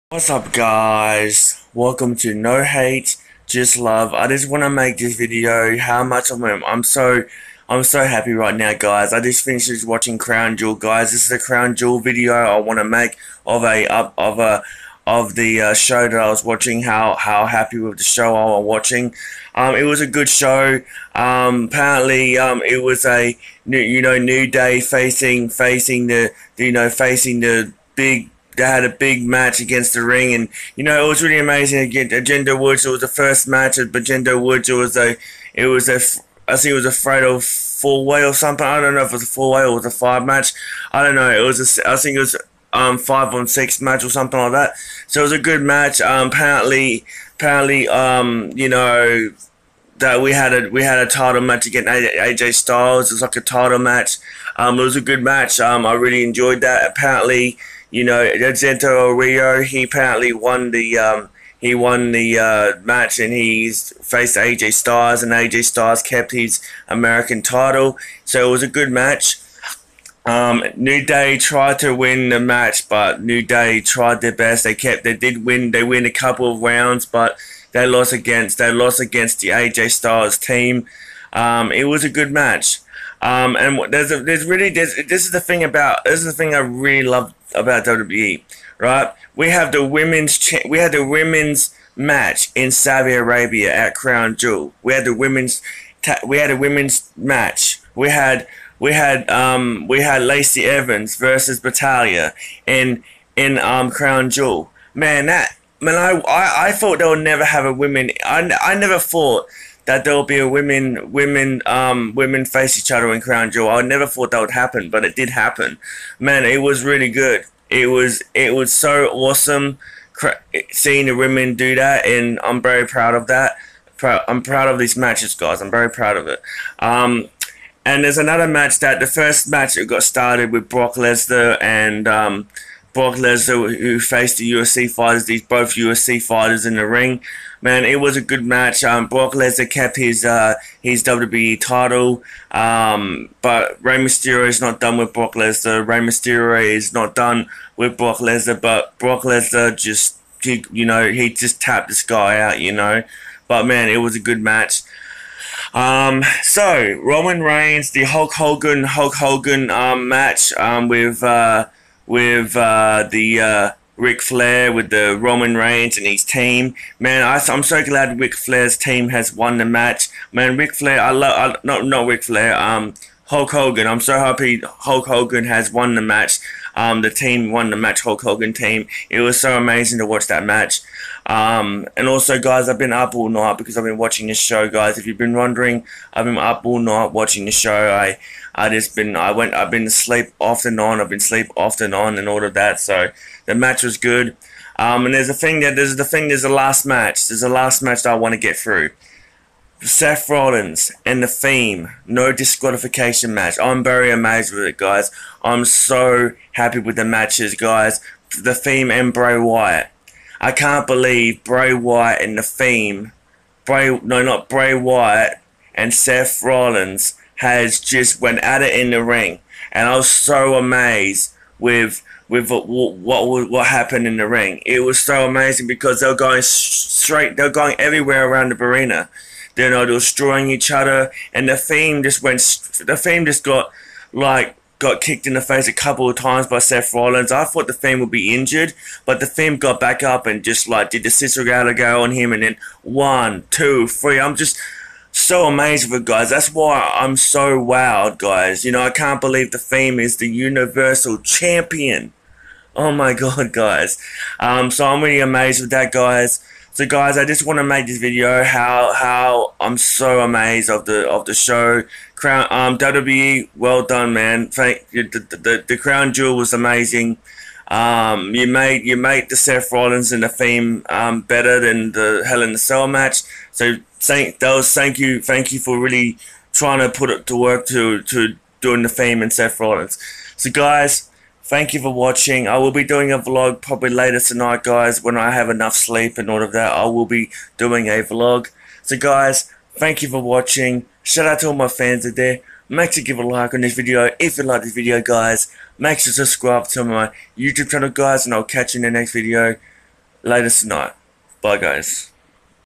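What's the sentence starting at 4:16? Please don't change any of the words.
So guys, I just want to make this video how how I'm so amazed of the of the show.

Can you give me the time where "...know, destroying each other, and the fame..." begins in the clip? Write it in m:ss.
3:49.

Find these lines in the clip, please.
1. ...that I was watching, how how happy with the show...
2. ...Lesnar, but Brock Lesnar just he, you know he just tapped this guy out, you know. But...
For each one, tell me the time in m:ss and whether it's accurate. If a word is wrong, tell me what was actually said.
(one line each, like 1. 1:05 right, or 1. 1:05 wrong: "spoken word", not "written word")
1. 0:16 right
2. 2:28 right.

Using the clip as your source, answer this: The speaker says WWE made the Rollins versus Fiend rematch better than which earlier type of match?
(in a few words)
Hell in the Cell.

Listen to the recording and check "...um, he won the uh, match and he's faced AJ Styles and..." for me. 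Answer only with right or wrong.
right.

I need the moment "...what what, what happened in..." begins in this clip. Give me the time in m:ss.
3:42.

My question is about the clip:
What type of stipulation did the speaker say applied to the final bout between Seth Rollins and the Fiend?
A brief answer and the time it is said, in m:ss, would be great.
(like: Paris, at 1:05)
No disqualification, at 3:22.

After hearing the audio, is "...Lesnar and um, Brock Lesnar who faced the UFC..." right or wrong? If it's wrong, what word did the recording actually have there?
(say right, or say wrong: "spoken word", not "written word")
right.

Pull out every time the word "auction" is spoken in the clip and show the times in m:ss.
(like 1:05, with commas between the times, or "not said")
not said.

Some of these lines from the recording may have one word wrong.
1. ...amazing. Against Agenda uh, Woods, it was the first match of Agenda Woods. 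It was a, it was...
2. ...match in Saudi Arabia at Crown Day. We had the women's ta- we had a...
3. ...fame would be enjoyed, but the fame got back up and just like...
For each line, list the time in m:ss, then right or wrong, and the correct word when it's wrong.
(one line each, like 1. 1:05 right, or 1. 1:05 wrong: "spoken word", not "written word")
1. 0:31 right
2. 1:31 wrong: "Jewel", not "Day"
3. 3:57 wrong: "injured", not "enjoyed".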